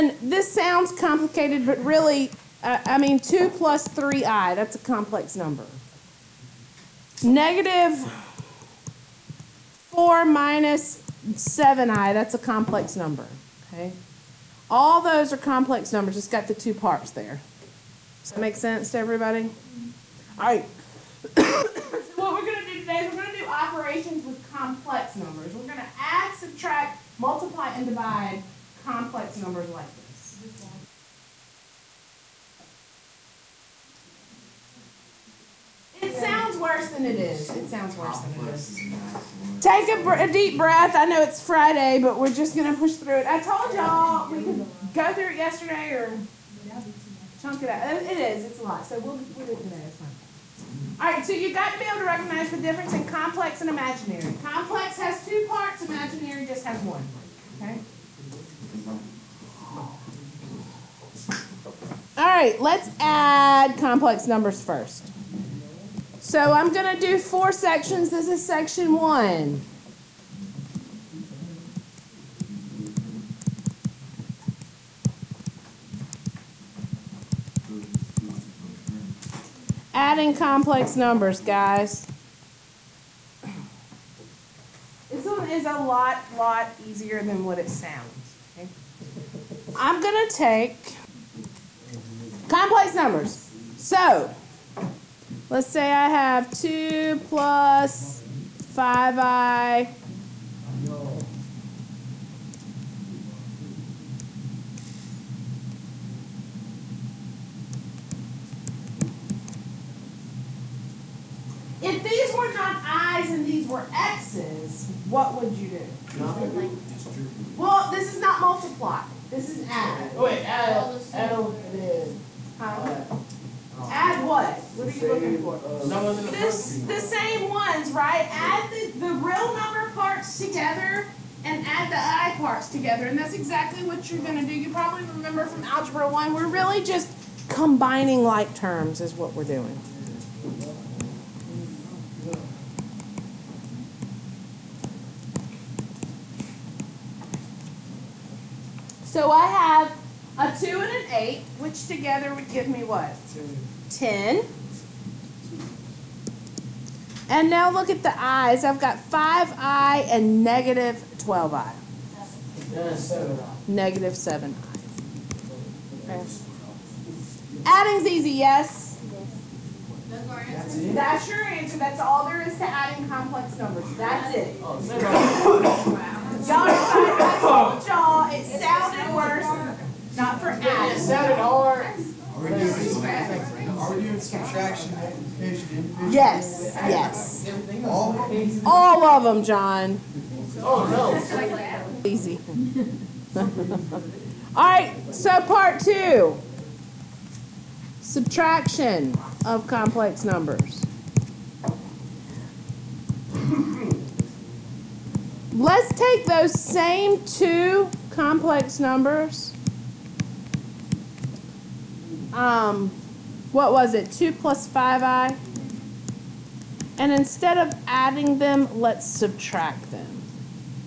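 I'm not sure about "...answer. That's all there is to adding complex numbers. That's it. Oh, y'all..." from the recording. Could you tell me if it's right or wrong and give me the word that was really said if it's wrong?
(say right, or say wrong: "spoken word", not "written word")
right.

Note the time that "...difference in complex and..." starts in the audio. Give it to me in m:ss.
0:52.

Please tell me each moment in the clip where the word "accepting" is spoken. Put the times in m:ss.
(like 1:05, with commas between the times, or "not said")
not said.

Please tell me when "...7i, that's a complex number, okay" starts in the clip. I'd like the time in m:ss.
0:11.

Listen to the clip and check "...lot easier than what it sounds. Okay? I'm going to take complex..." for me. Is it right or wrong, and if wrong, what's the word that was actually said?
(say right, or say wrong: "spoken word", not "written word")
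right.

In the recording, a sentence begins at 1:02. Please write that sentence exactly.
All right, let's add complex numbers first.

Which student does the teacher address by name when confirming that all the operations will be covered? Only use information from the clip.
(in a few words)
John.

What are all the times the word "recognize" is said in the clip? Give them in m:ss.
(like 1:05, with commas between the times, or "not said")
0:52.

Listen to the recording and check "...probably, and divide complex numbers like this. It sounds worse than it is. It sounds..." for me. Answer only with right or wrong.
wrong.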